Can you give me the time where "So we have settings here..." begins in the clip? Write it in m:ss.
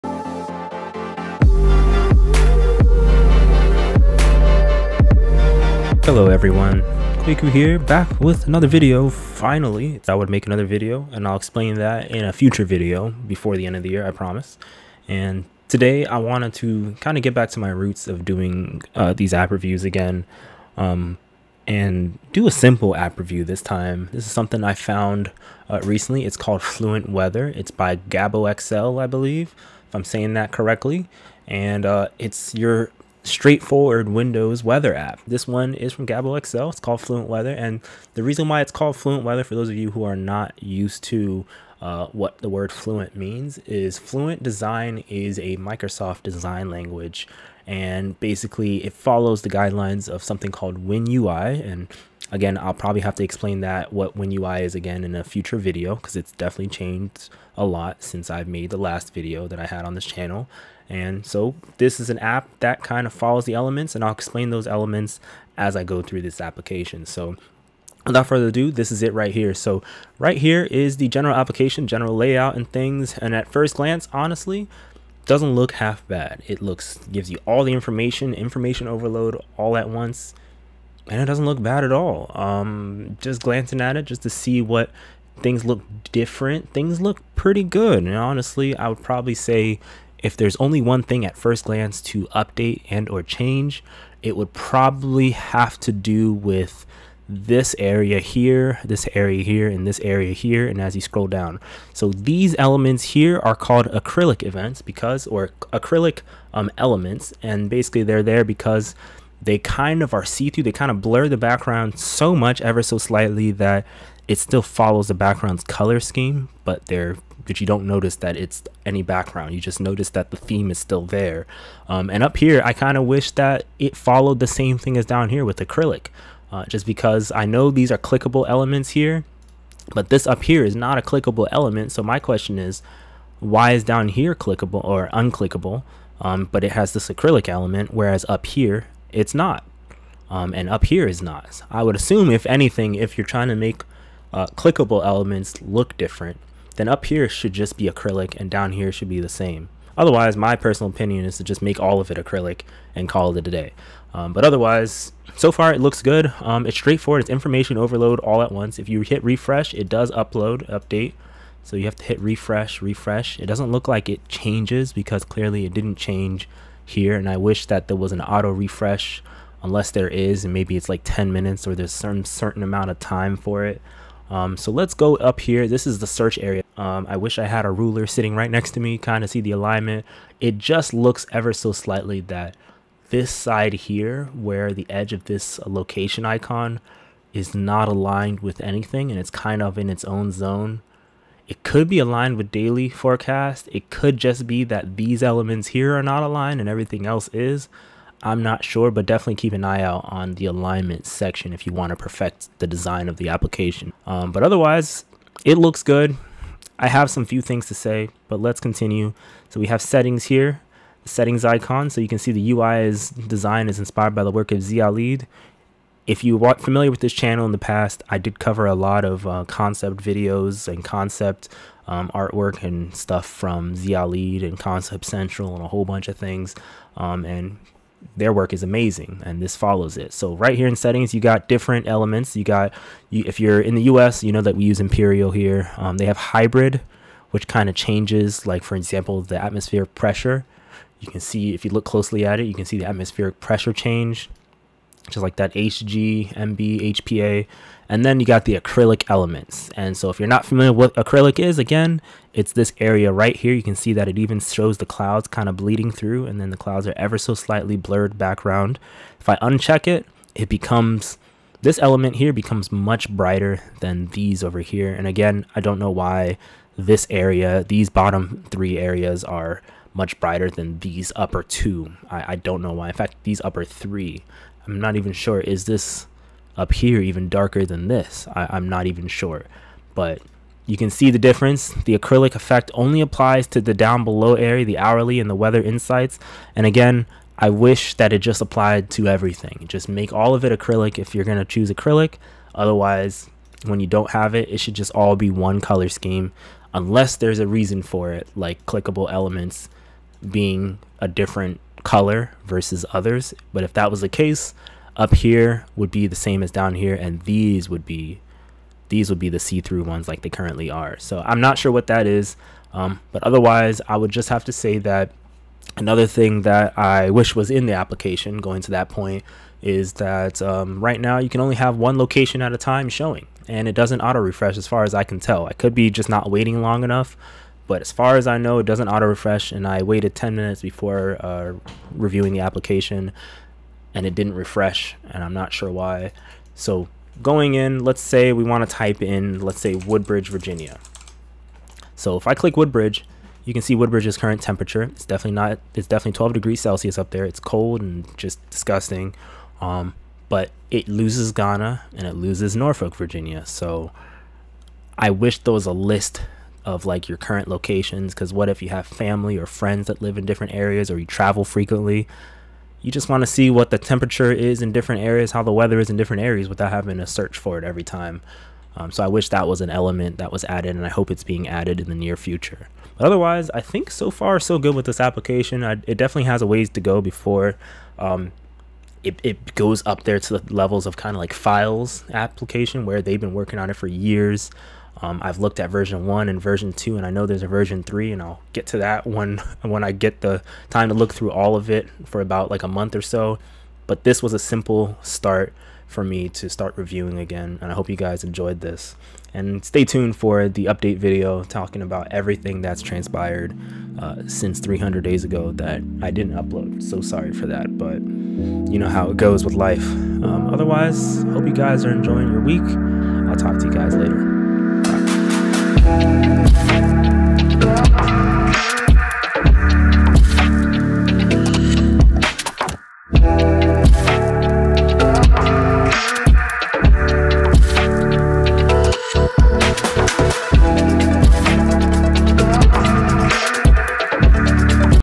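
3:29.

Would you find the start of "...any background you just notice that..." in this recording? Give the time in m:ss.
1:58.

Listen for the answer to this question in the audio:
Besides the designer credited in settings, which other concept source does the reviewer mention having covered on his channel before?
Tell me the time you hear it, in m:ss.
3:44.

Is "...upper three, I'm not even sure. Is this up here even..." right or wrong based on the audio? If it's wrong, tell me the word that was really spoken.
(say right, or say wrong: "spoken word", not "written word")
right.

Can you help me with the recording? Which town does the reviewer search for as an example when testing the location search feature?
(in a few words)
Woodbridge, Virginia.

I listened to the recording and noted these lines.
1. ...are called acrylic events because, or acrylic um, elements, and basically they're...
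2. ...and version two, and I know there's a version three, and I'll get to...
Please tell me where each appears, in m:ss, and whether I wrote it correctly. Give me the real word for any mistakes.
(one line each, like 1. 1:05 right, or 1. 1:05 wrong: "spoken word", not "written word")
1. 1:43 right
2. 6:26 right.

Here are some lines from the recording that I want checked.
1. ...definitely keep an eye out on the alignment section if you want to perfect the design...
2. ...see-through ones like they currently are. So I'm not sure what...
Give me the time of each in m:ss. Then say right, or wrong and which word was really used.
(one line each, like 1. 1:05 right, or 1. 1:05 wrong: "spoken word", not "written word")
1. 3:19 right
2. 5:09 right.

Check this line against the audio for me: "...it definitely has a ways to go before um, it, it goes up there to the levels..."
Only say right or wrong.
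right.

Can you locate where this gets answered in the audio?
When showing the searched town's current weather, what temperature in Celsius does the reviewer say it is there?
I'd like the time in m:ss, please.
5:46.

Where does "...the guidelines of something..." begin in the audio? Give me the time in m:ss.
0:49.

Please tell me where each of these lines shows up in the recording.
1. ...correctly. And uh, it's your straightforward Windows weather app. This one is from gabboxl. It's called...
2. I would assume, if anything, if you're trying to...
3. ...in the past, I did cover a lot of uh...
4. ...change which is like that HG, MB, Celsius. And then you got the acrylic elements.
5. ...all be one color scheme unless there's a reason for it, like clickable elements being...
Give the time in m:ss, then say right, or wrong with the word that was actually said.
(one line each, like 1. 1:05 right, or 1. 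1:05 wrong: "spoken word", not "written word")
1. 0:30 right
2. 2:21 right
3. 3:37 right
4. 4:03 wrong: "HPA", not "Celsius"
5. 4:54 right.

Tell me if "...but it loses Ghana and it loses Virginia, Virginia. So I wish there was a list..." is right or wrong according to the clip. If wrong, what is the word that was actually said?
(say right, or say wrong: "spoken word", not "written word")
wrong: "Norfolk", not "Virginia".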